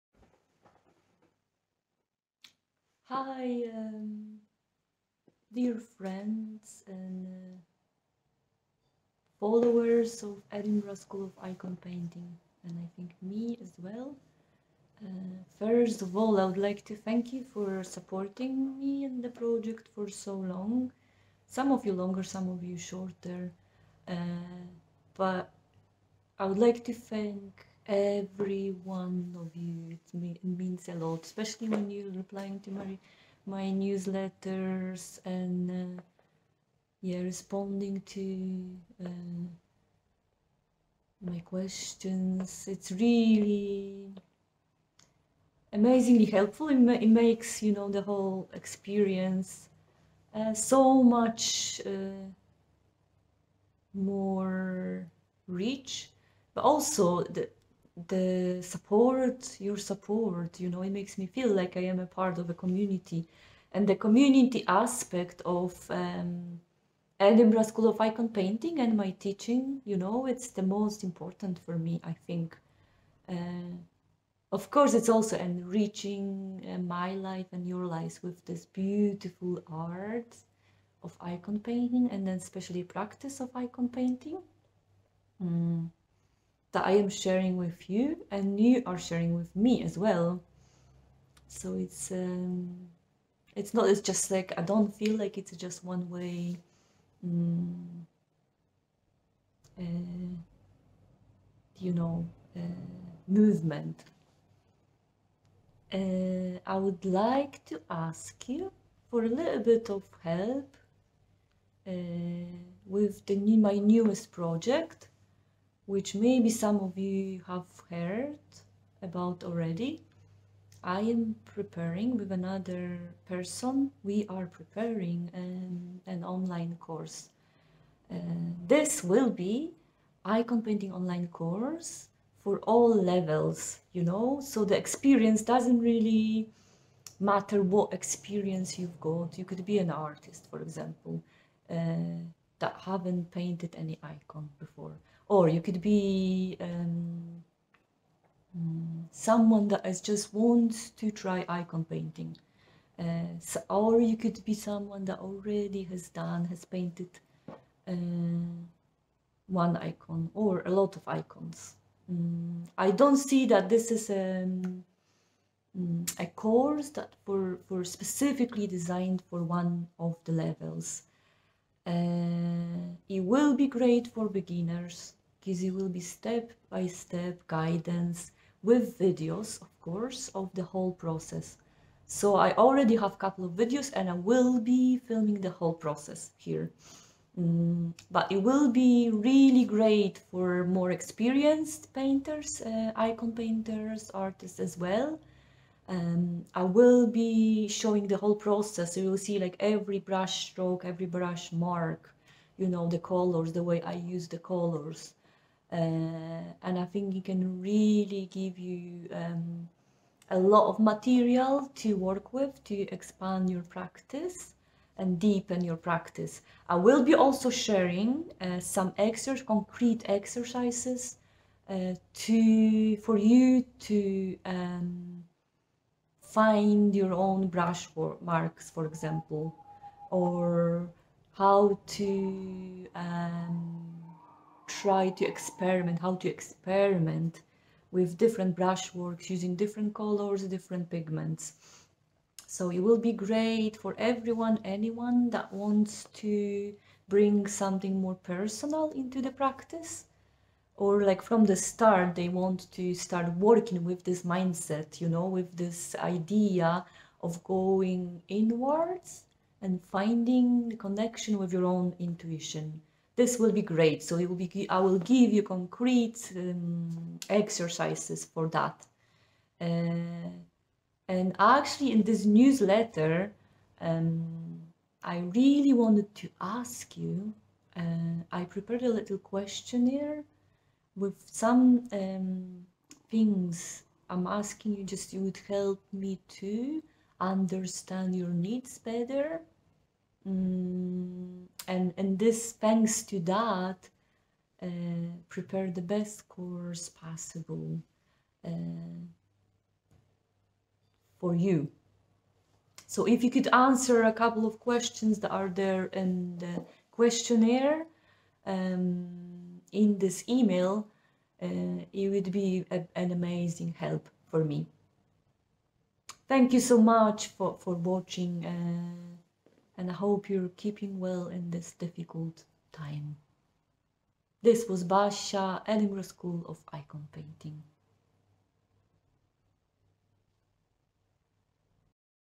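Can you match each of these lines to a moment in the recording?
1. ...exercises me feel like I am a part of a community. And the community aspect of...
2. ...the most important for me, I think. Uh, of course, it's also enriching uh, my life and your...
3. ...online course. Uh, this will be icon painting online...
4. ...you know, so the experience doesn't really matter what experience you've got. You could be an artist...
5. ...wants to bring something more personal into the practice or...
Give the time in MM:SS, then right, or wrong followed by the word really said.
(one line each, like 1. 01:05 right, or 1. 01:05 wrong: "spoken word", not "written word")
1. 01:00 wrong: "makes", not "exercises"
2. 01:10 right
3. 02:06 right
4. 02:13 right
5. 04:05 right.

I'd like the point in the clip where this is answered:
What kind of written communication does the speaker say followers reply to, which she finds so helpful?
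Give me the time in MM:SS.
00:33.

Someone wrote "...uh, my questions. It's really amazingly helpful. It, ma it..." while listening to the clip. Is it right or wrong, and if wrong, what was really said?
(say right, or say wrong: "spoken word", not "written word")
right.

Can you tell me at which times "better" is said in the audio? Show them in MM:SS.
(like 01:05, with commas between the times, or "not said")
04:48.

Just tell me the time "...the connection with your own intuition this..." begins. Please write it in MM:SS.
04:20.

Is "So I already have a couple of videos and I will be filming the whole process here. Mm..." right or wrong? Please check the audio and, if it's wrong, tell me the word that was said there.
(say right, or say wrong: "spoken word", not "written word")
right.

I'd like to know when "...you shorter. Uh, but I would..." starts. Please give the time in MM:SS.
00:22.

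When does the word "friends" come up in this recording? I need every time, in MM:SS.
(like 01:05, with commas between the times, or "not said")
00:05.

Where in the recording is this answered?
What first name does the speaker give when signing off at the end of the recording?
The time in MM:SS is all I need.
05:24.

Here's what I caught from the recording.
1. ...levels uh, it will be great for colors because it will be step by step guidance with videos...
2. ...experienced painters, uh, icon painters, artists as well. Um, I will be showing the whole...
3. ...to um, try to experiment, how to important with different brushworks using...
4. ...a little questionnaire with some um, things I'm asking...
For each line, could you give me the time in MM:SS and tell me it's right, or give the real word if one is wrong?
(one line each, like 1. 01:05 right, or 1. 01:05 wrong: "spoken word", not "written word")
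1. 02:50 wrong: "beginners", not "colors"
2. 03:10 right
3. 03:51 wrong: "experiment", not "important"
4. 04:38 right.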